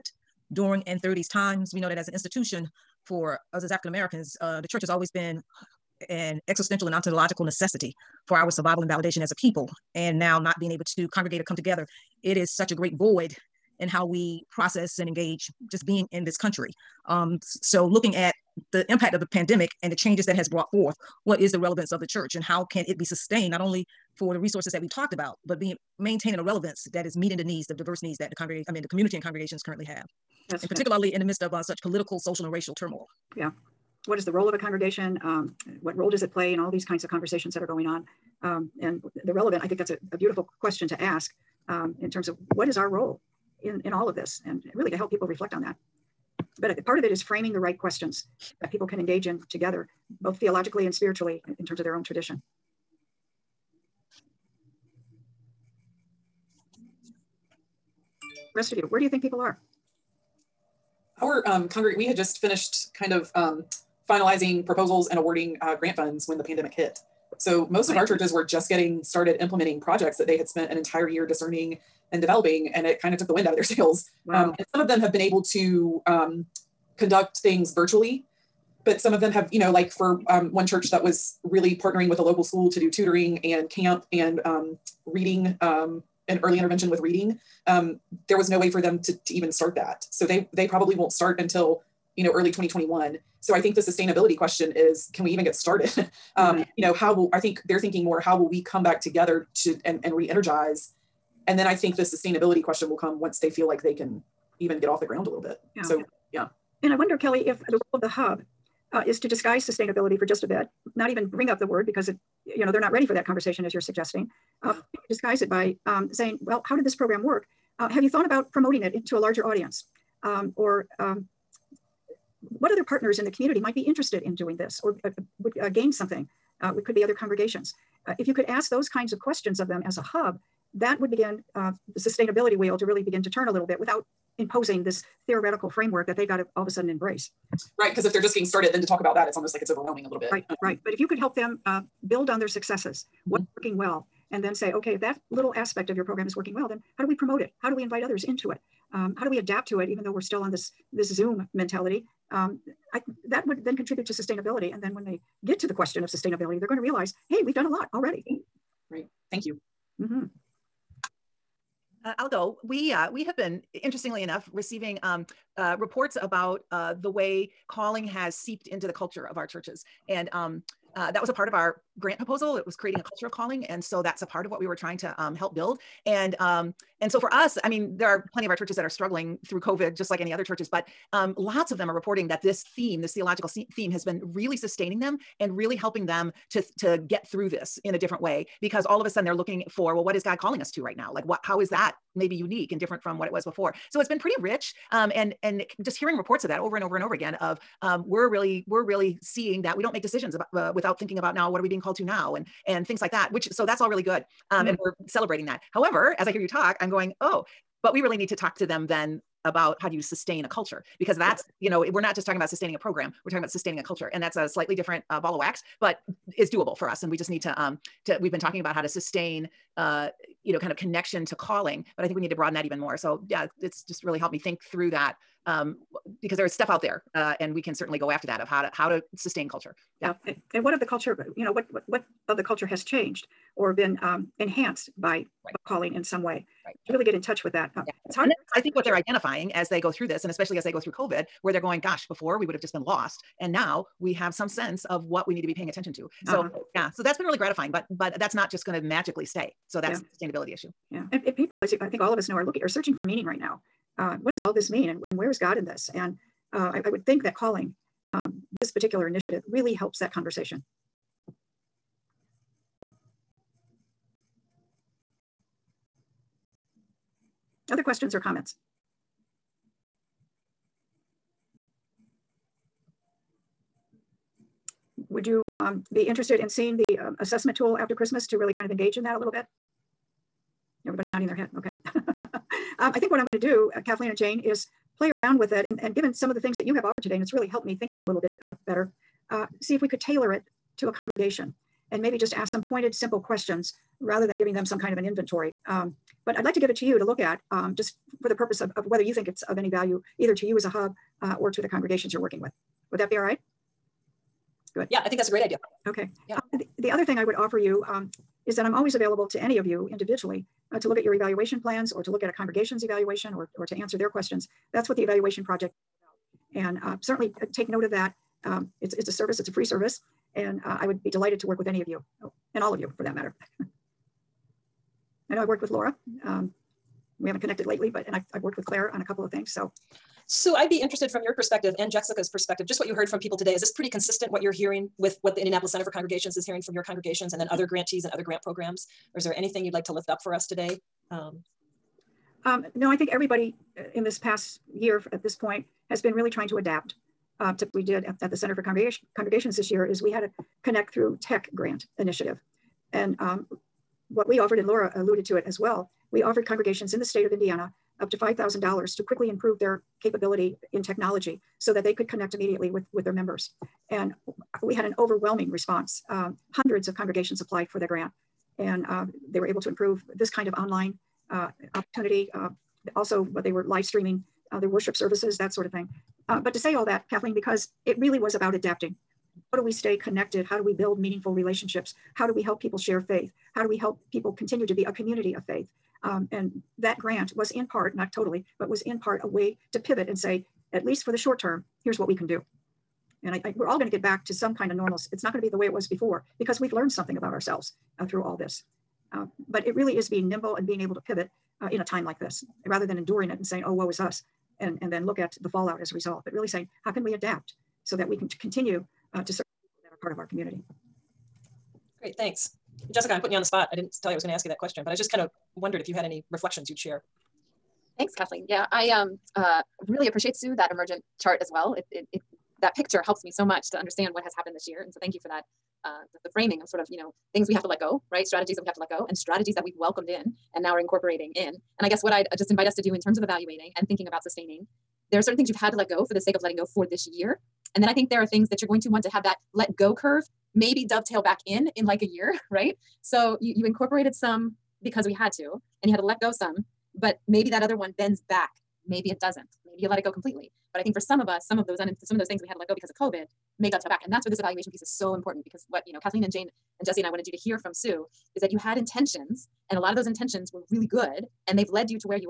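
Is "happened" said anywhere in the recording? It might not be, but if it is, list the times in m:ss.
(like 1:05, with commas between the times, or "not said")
7:04.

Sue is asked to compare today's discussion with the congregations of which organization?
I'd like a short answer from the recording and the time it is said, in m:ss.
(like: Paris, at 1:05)
Indianapolis Center for Congregations, at 5:35.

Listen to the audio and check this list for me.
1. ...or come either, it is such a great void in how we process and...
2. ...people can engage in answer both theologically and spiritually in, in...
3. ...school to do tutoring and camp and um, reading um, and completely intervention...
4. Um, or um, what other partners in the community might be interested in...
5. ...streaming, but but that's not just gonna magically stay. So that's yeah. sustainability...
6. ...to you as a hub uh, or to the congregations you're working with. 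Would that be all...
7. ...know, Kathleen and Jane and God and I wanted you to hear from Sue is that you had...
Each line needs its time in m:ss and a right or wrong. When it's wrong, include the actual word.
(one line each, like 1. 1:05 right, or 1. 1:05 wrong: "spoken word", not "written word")
1. 0:11 wrong: "together", not "either"
2. 0:48 wrong: "together", not "answer"
3. 1:22 wrong: "early", not "completely"
4. 2:00 right
5. 4:07 wrong: "gratifying", not "streaming"
6. 5:00 right
7. 7:35 wrong: "Jesse", not "God".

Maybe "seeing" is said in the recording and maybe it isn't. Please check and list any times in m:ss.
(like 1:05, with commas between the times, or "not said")
3:19, 4:36.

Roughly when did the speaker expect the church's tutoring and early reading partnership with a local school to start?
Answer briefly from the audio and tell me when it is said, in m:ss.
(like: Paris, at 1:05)
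early 2021, at 1:32.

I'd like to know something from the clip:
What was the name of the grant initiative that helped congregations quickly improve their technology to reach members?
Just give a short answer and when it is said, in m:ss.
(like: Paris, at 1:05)
Connect Through Tech, at 5:50.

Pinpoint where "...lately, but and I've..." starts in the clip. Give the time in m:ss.
5:27.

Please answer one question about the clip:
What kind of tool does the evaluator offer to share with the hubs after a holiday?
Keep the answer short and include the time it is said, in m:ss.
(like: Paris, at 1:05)
assessment tool, at 4:37.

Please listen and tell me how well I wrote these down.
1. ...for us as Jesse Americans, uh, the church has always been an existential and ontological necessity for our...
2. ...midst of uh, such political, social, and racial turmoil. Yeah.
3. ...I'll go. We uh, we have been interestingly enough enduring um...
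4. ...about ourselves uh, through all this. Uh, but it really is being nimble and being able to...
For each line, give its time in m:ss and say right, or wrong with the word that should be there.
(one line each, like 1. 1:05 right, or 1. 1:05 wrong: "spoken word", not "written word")
1. 0:03 wrong: "African", not "Jesse"
2. 0:31 right
3. 2:42 wrong: "receiving", not "enduring"
4. 6:37 right.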